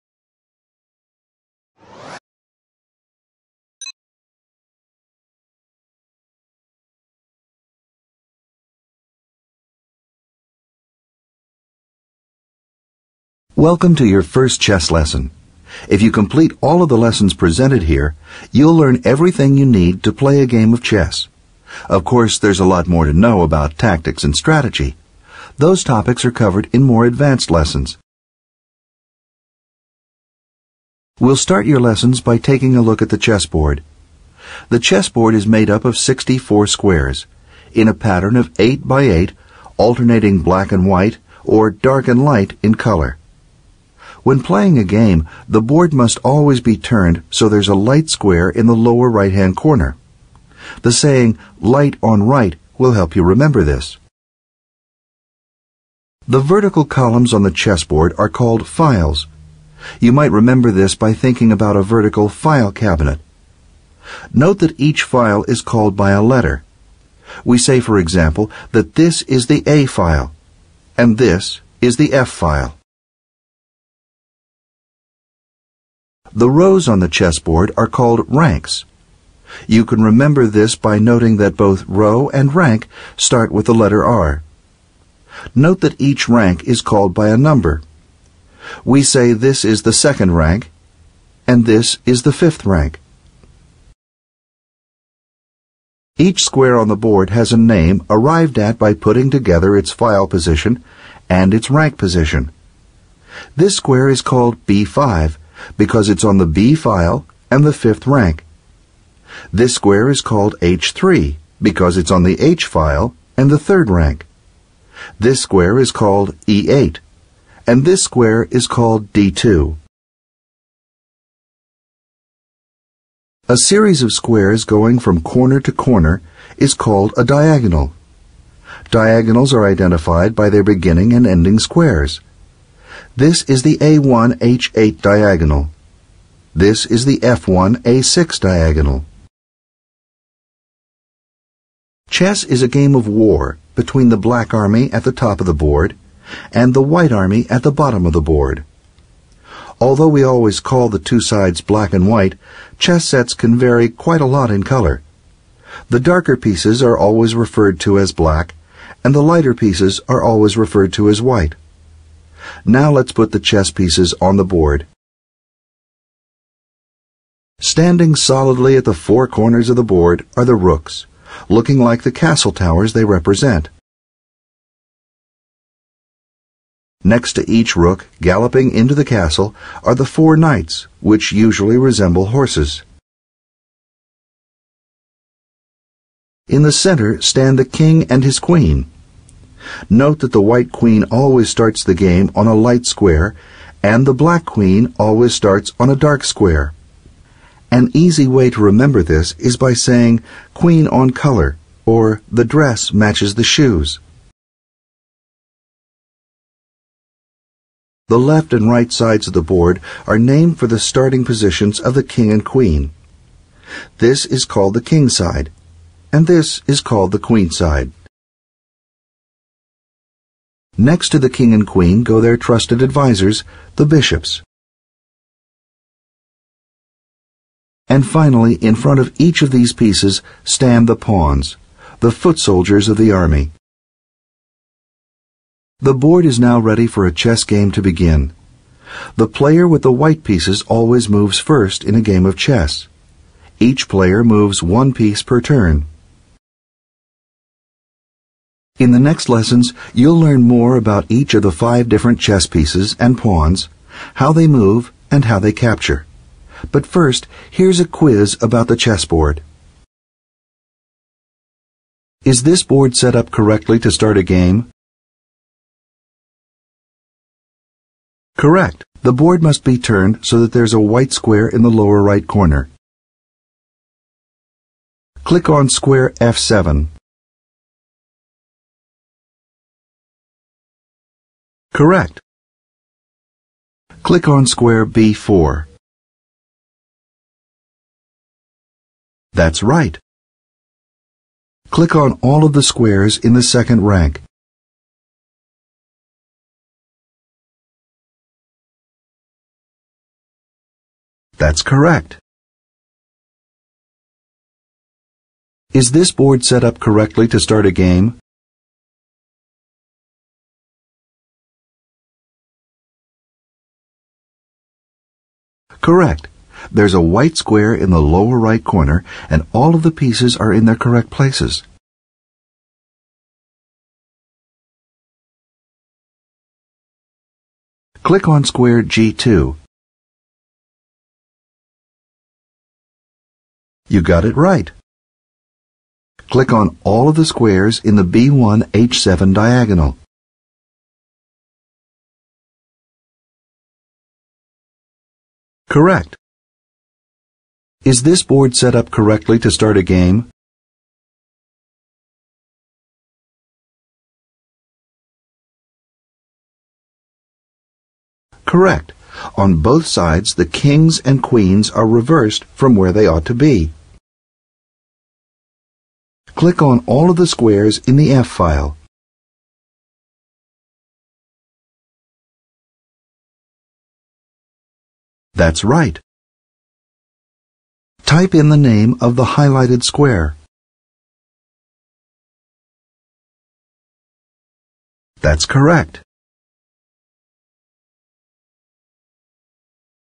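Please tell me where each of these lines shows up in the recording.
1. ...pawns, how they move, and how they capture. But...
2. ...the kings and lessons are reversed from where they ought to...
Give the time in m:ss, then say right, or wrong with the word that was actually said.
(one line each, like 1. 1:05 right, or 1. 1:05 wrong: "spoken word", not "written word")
1. 4:13 right
2. 6:00 wrong: "queens", not "lessons".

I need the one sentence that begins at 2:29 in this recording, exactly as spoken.
Although we always call the two sides black and white, chess sets can vary quite a lot in color.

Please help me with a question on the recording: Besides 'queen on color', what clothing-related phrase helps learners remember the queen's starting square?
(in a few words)
the dress matches the shoes.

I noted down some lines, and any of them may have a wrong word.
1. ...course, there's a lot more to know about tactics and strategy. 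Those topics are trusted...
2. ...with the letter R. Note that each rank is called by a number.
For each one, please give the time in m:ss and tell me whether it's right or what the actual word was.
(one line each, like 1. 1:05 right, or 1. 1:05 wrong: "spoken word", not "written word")
1. 0:22 wrong: "covered", not "trusted"
2. 1:23 right.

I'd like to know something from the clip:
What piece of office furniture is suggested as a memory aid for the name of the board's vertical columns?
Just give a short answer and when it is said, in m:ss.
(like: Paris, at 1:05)
vertical file cabinet, at 1:01.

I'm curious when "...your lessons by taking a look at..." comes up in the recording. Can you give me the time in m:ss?
0:31.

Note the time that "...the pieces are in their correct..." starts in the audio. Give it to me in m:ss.
5:19.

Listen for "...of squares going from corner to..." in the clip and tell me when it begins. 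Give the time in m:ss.
2:04.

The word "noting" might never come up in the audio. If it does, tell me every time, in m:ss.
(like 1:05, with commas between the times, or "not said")
1:20.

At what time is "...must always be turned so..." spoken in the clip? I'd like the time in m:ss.
0:45.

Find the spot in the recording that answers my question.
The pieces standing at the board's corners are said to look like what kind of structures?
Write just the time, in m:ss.
2:52.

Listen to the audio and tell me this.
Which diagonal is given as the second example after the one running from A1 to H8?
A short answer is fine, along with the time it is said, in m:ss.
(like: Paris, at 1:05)
F1A6, at 2:17.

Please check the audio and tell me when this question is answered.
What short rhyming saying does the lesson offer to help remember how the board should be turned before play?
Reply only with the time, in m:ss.
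0:51.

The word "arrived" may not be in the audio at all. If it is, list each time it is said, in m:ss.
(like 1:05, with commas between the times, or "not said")
1:38.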